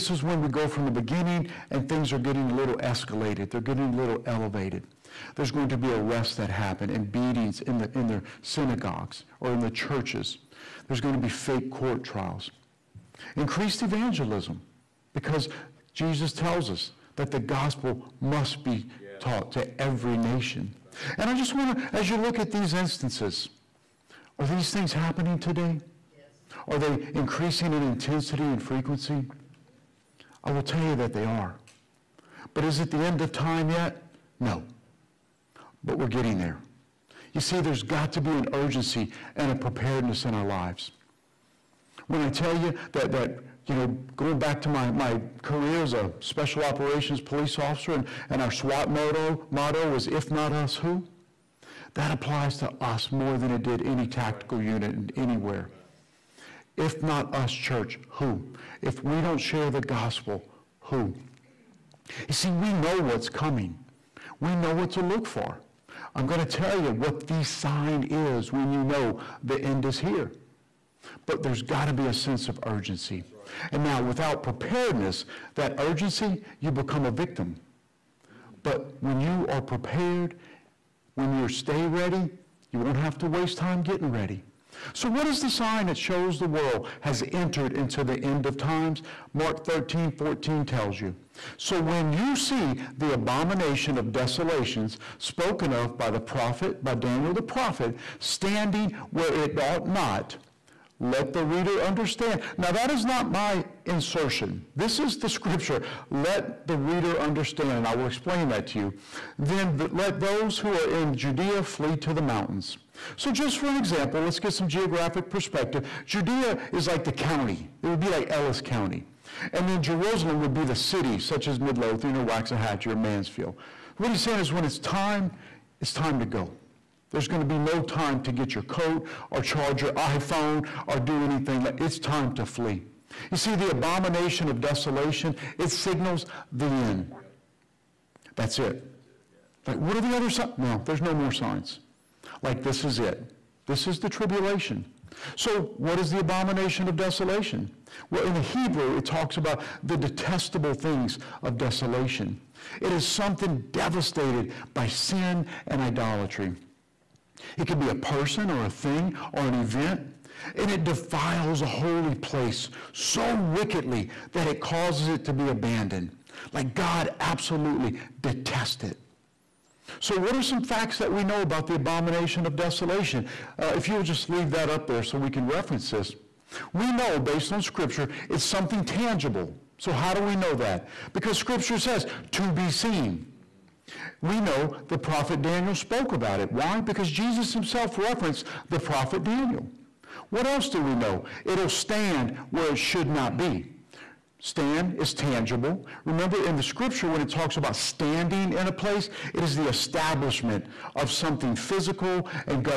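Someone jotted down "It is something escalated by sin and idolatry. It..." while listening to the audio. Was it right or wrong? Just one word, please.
wrong.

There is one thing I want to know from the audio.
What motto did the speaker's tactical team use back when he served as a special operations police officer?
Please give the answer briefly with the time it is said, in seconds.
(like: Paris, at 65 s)
If not us, who?, at 50 s.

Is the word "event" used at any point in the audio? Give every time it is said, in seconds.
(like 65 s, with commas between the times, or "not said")
159 s.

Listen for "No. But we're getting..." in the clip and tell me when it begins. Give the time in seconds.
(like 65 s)
34 s.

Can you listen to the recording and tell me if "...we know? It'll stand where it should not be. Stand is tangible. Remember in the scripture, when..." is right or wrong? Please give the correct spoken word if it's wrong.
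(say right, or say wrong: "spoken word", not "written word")
right.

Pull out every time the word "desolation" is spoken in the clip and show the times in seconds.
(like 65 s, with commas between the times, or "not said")
94 s, 134 s, 146 s, 151 s, 172 s.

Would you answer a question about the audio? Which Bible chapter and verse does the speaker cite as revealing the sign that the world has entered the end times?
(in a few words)
Mark 13:14.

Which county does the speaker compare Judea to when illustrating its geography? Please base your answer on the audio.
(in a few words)
Ellis County.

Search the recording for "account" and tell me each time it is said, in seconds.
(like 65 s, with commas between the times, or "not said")
not said.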